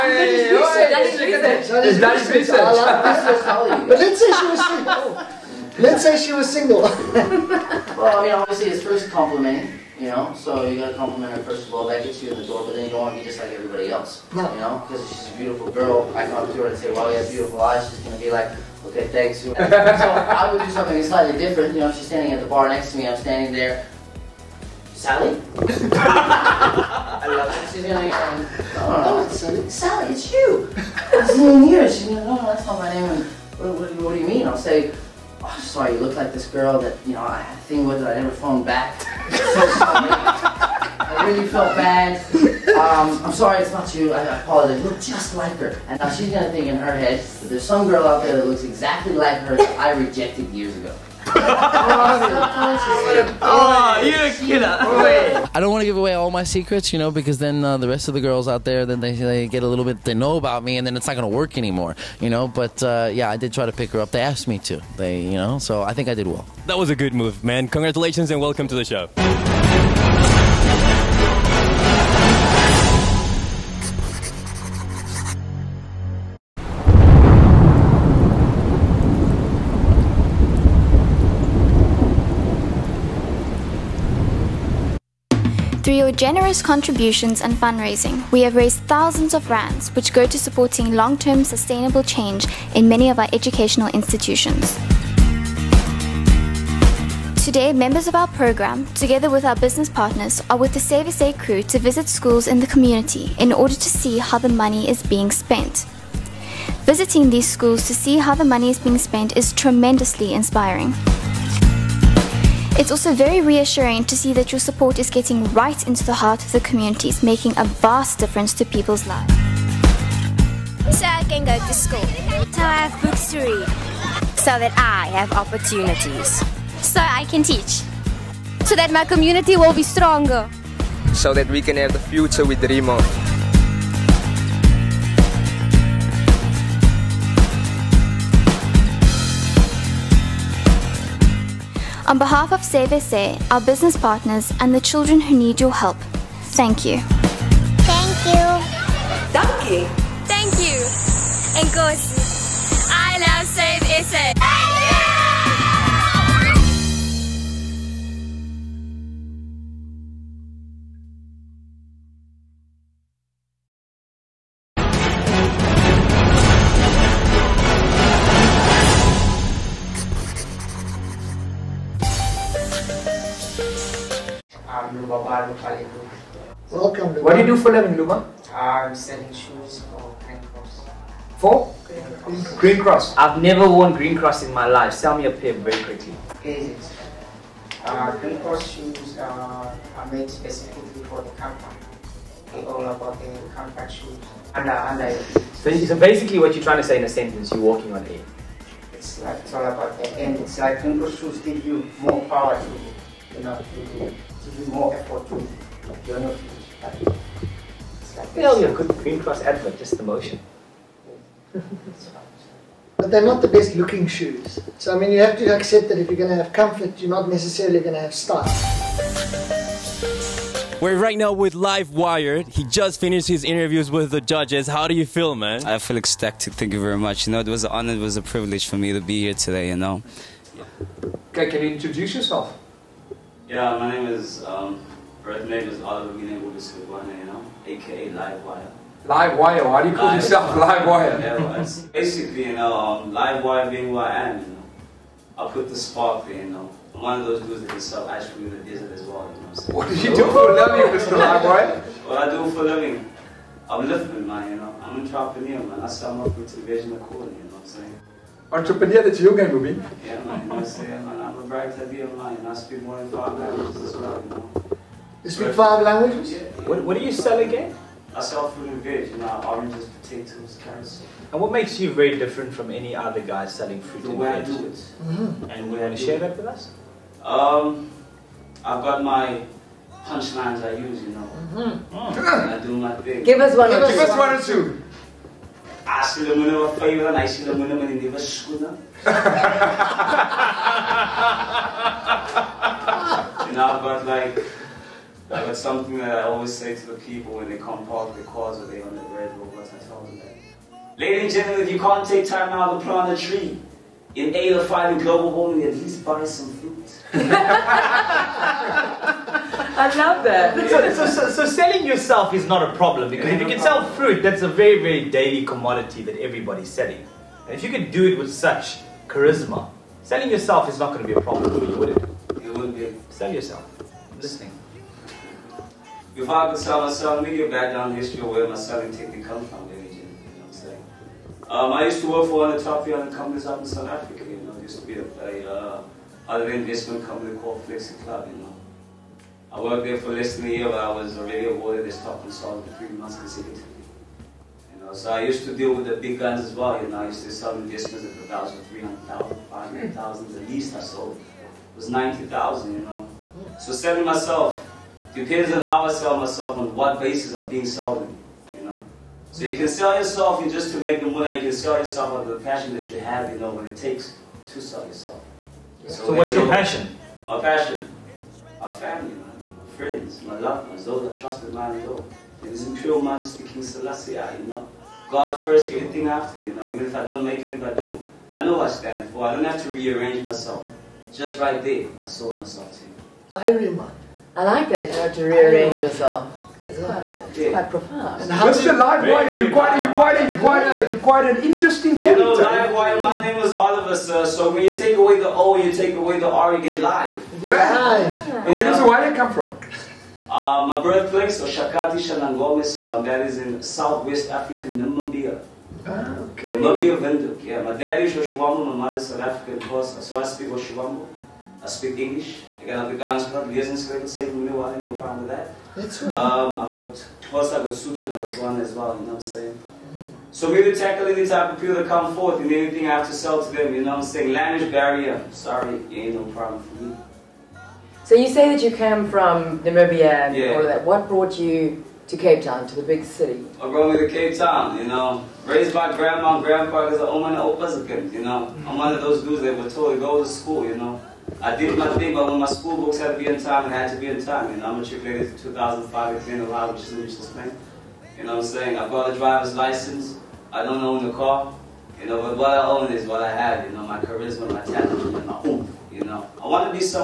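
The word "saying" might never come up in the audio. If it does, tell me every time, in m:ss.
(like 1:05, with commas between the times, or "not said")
4:17, 6:59, 7:04, 7:28.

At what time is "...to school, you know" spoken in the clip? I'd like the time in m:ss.
7:20.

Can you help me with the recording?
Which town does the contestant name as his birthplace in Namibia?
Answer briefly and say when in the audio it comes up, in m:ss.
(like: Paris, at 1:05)
Oshakati, at 6:41.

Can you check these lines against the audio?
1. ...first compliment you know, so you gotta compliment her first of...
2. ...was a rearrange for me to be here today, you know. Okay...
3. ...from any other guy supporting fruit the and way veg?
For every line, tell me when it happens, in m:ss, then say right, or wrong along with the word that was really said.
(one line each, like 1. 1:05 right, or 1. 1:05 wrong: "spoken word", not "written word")
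1. 0:08 right
2. 3:47 wrong: "privilege", not "rearrange"
3. 4:32 wrong: "selling", not "supporting".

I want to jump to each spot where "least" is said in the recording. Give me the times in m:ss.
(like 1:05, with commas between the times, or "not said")
5:05, 5:50.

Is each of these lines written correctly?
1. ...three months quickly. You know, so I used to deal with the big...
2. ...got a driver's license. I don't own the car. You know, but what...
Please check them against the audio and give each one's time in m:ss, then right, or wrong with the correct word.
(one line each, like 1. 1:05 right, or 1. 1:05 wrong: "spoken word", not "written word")
1. 5:42 wrong: "consecutively", not "quickly"
2. 7:28 right.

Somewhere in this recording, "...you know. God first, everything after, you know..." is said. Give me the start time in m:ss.
6:14.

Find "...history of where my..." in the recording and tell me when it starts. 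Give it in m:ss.
5:27.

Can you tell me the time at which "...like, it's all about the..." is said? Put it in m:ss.
3:19.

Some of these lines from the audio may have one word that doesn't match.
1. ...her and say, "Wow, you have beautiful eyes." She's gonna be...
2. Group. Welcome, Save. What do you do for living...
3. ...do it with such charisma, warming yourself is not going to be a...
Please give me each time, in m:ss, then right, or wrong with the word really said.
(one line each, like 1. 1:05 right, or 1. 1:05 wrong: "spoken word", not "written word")
1. 0:16 right
2. 2:55 wrong: "Luma", not "Save"
3. 5:17 wrong: "selling", not "warming".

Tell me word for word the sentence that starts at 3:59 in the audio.
Livewire, why do you call Live yourself Livewire?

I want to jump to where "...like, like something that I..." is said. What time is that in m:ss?
4:54.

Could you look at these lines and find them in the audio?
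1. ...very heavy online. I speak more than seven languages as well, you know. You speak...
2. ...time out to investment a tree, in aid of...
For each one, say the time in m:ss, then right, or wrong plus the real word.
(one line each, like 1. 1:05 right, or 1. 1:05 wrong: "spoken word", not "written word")
1. 4:21 wrong: "five", not "seven"
2. 5:02 wrong: "plant", not "investment".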